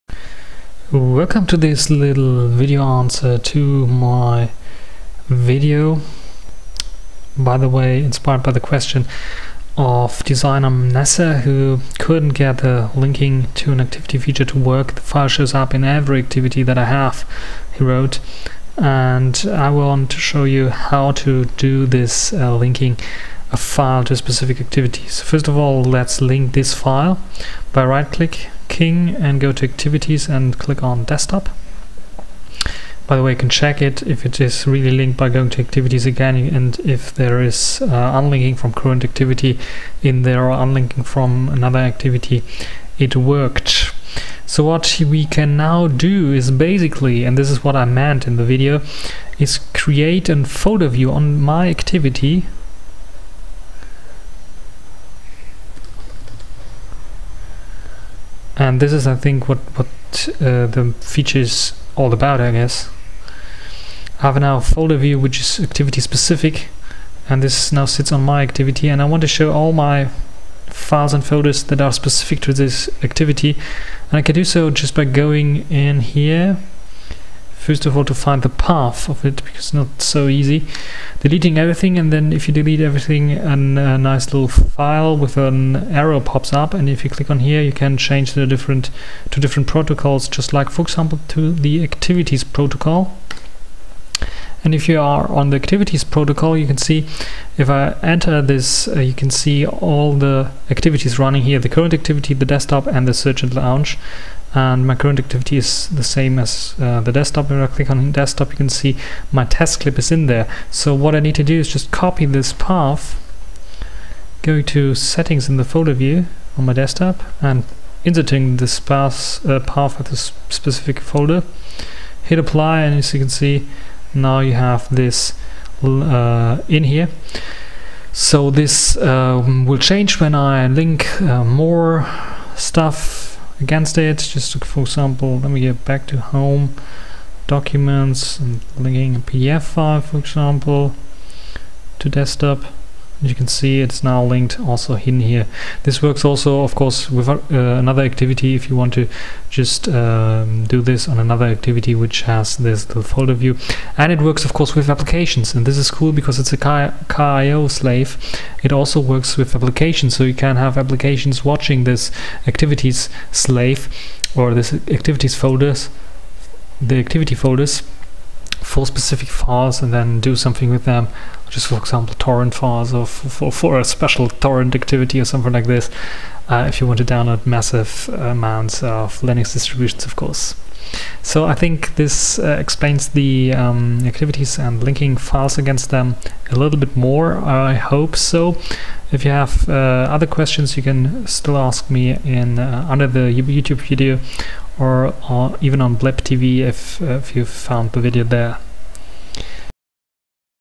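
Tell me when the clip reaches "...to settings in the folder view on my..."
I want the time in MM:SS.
01:54.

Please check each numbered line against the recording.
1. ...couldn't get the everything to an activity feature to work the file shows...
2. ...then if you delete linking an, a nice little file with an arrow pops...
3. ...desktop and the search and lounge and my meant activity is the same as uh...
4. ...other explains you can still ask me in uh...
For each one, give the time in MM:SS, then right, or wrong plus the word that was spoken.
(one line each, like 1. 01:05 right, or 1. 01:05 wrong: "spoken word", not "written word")
1. 00:11 wrong: "linking", not "everything"
2. 01:22 wrong: "everything", not "linking"
3. 01:42 wrong: "current", not "meant"
4. 03:10 wrong: "questions", not "explains".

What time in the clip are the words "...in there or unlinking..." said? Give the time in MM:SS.
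00:40.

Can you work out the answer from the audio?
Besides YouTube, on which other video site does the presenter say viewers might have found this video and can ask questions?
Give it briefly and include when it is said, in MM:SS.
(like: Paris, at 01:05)
Blip TV, at 03:15.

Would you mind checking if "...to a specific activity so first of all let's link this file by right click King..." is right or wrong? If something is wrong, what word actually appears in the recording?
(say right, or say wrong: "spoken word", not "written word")
right.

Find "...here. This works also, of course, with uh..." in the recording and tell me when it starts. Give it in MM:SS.
02:25.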